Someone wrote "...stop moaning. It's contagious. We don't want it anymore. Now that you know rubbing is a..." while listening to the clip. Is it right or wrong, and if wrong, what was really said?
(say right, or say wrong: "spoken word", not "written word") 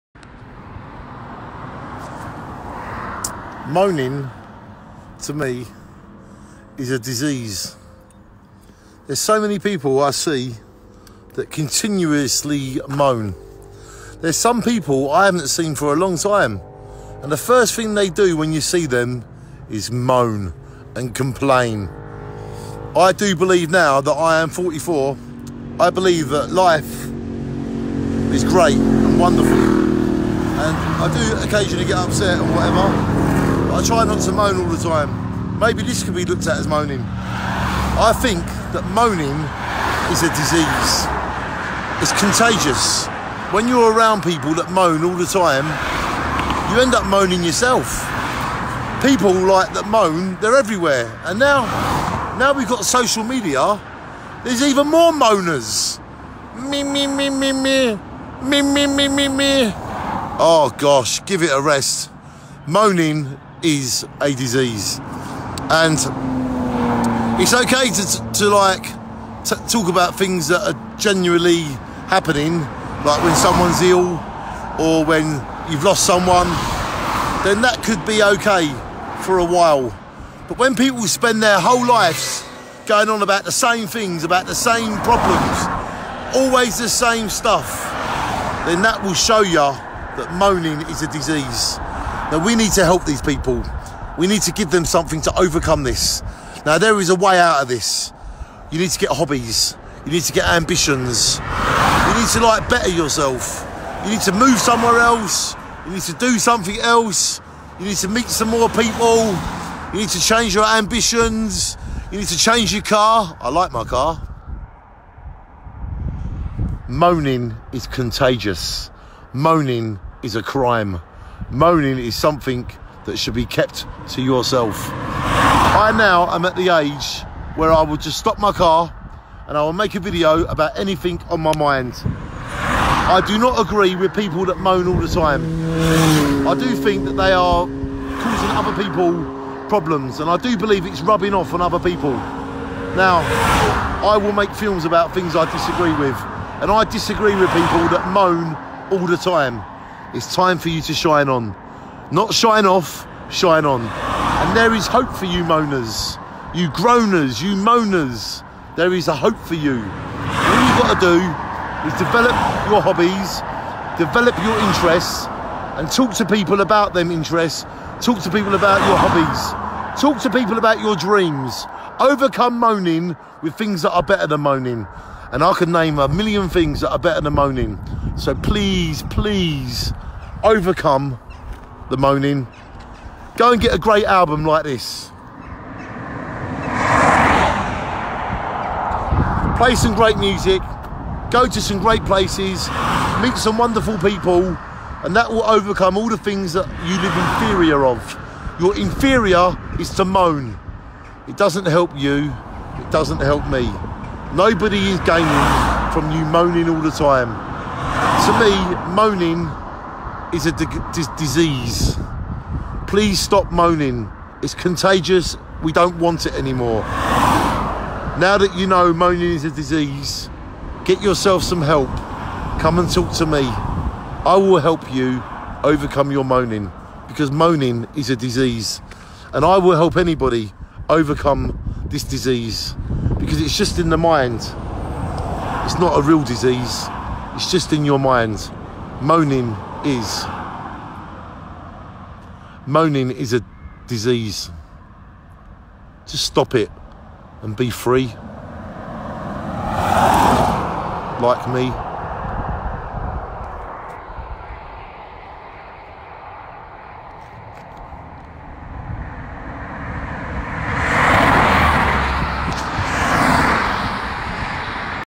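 wrong: "moaning", not "rubbing".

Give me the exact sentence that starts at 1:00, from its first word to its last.
Oh gosh, give it a rest.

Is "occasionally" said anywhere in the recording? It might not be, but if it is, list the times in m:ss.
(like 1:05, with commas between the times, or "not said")
0:31.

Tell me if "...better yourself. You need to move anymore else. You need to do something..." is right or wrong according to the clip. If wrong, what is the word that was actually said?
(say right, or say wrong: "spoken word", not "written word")
wrong: "somewhere", not "anymore".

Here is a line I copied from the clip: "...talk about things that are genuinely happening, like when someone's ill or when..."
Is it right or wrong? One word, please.
right.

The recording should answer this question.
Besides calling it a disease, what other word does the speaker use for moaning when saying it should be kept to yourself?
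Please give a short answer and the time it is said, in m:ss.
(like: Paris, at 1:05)
crime, at 2:00.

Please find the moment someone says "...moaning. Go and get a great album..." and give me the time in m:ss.
3:01.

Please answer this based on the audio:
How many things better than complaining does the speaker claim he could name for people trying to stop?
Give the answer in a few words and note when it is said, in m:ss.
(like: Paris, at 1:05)
a million, at 2:55.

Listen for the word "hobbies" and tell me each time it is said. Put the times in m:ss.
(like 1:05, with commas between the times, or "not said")
1:39, 2:42, 2:48.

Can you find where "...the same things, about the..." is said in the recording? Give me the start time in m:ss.
1:23.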